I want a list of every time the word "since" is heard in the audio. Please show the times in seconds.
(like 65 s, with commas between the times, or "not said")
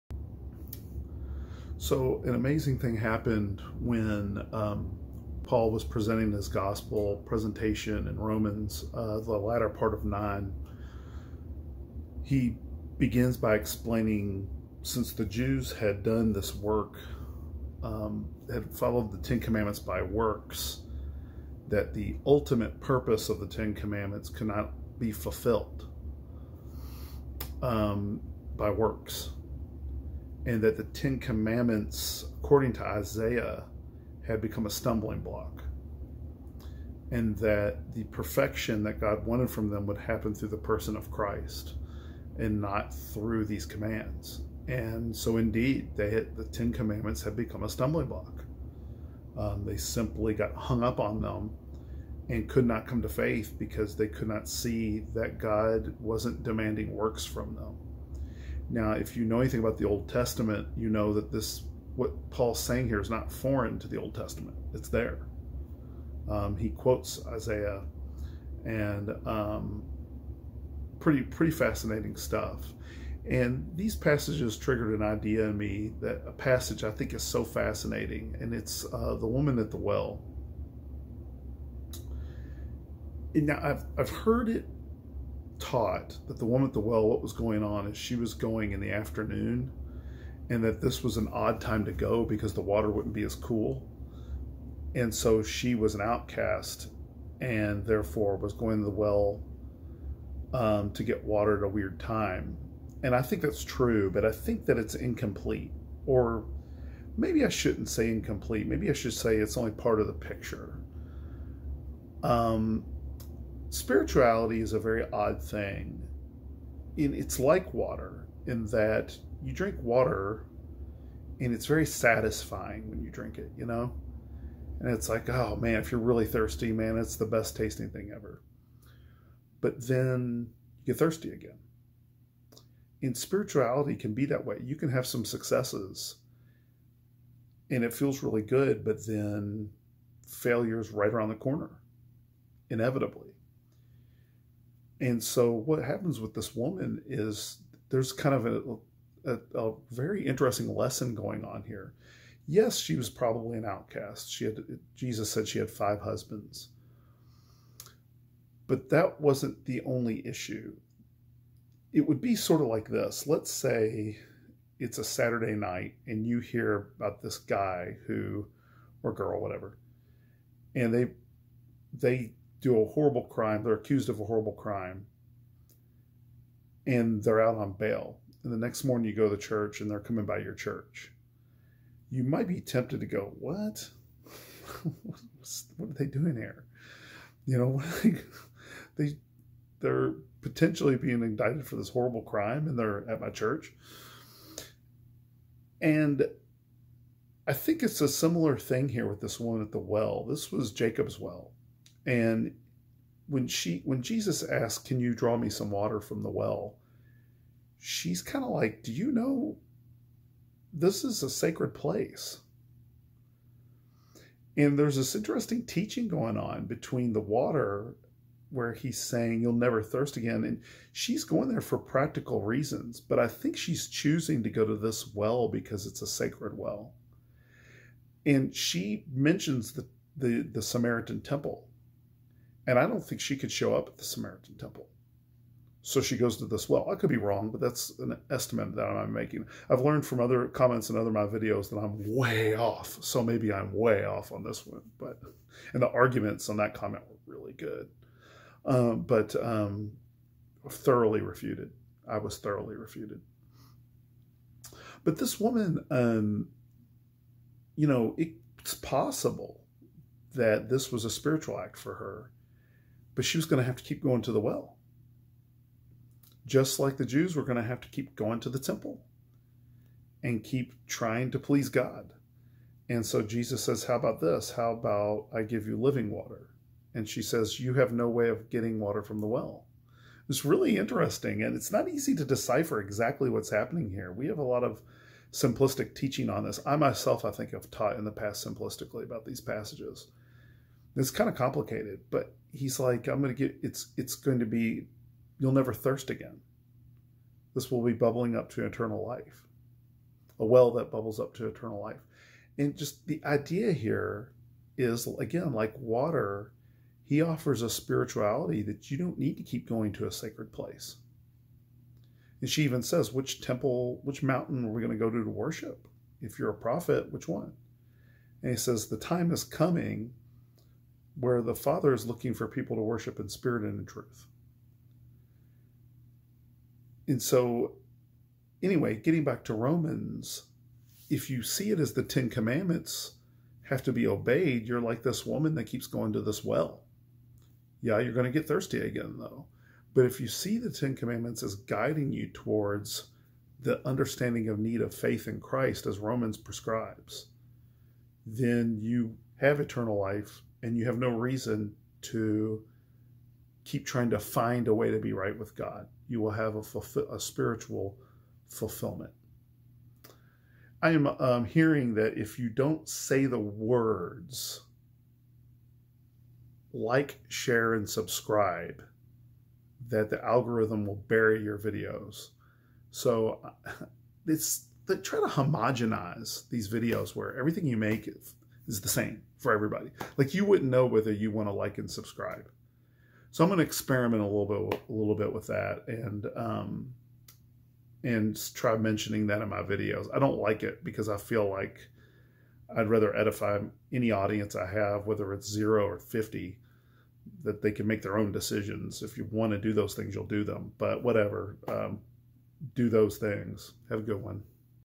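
14 s.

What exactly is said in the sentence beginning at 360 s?
I am um, hearing that if you don't say the words, like, share, and subscribe, that the algorithm will bury your videos.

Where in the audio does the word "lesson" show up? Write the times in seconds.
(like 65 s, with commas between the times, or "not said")
150 s.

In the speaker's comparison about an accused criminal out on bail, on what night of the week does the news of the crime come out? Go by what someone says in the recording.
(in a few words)
Saturday.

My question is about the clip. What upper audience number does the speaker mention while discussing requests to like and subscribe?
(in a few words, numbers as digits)
50.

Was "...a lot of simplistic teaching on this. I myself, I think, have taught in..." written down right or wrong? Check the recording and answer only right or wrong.
right.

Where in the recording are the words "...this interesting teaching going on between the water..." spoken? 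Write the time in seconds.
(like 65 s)
214 s.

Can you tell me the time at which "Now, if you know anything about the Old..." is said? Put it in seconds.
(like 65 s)
58 s.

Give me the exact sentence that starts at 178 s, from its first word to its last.
And the next morning you go to church and they're coming by your church.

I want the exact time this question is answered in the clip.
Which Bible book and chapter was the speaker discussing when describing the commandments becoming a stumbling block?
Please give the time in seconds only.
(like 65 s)
8 s.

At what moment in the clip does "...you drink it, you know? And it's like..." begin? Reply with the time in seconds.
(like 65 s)
123 s.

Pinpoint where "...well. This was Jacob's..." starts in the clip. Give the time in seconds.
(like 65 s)
199 s.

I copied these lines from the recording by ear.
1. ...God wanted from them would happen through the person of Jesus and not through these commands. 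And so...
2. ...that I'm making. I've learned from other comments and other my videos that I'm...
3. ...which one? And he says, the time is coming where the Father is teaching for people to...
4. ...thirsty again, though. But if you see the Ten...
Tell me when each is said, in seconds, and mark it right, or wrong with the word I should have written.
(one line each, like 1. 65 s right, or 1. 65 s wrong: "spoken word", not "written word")
1. 39 s wrong: "Christ", not "Jesus"
2. 238 s right
3. 317 s wrong: "looking", not "teaching"
4. 338 s right.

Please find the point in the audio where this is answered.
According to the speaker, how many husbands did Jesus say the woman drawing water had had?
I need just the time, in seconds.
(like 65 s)
155 s.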